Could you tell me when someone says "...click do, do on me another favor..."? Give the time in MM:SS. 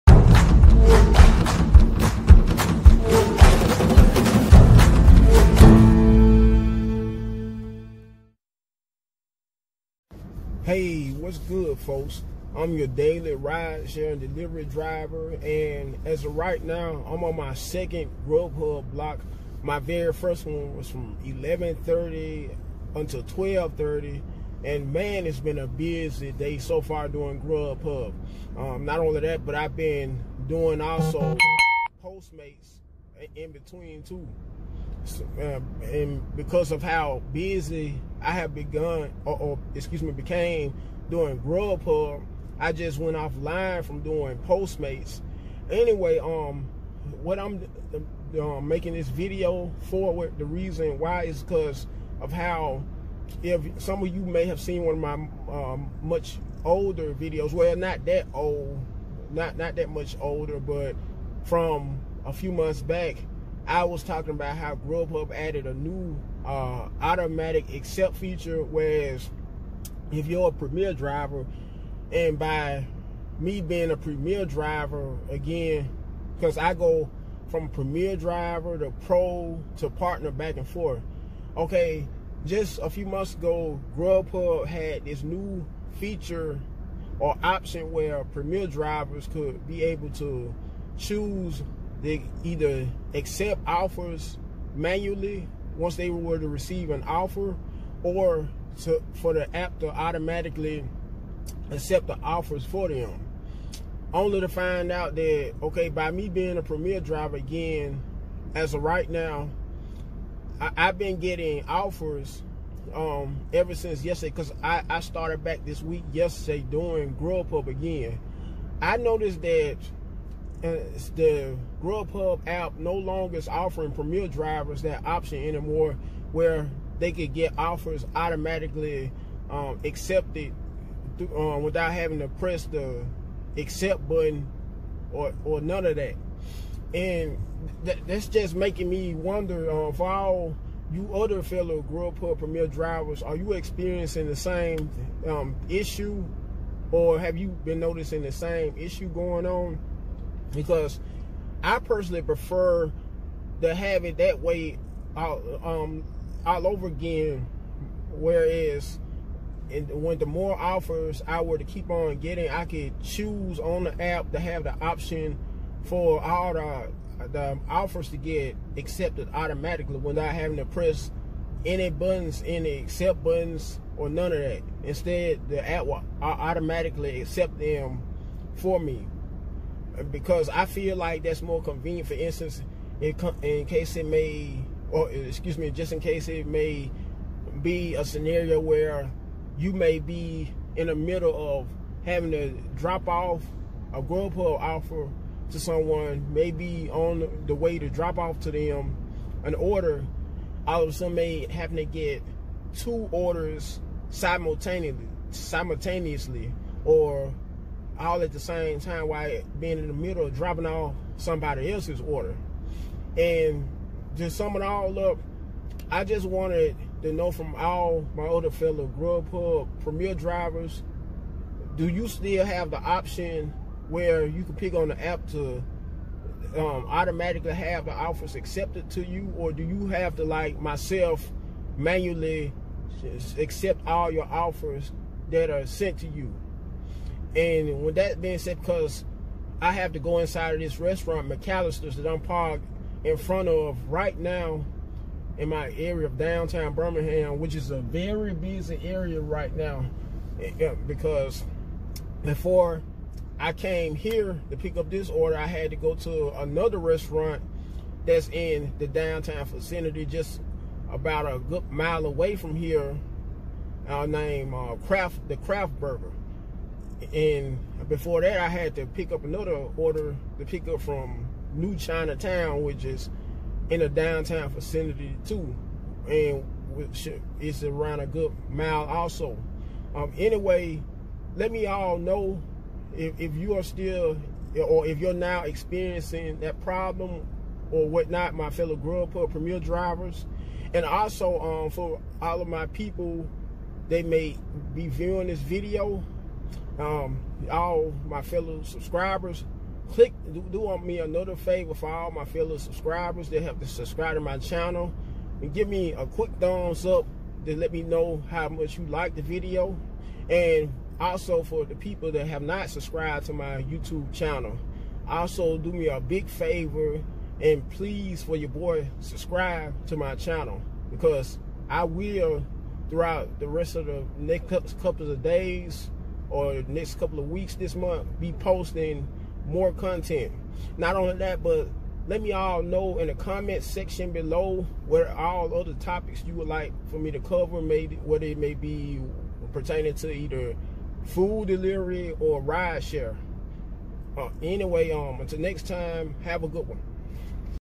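04:59.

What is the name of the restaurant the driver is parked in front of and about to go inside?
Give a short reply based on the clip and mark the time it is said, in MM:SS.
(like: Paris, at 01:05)
McAlister's, at 04:01.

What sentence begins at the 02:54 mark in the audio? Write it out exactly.
Instead, the app will automatically accept them for me because I feel like that's more convenient.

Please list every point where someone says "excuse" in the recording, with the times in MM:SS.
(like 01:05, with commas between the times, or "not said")
00:39, 03:05.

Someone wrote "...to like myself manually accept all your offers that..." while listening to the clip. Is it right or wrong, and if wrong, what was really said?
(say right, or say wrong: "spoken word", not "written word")
right.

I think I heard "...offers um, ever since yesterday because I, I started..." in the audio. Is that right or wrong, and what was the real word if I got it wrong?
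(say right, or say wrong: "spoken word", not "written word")
right.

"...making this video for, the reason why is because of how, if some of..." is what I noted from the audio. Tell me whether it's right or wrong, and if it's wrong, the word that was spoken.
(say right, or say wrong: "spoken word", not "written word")
right.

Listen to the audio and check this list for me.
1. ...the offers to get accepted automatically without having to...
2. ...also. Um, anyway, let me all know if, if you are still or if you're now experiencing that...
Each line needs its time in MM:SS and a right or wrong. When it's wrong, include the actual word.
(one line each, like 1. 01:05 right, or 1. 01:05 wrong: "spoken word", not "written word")
1. 02:47 right
2. 04:38 right.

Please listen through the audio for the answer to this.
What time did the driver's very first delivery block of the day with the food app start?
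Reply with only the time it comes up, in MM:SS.
00:21.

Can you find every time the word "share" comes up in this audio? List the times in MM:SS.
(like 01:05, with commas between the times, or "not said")
00:13, 05:42.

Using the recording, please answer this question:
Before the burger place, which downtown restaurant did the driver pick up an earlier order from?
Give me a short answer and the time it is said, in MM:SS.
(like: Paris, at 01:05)
New Chinatown, at 04:31.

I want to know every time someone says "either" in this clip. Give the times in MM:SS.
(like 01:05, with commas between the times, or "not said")
01:32, 05:40.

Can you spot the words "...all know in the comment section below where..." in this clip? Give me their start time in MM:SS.
05:32.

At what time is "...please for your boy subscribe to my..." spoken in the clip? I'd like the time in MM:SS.
05:17.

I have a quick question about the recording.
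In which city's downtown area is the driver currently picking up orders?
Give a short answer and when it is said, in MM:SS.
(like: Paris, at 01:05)
Birmingham, at 04:06.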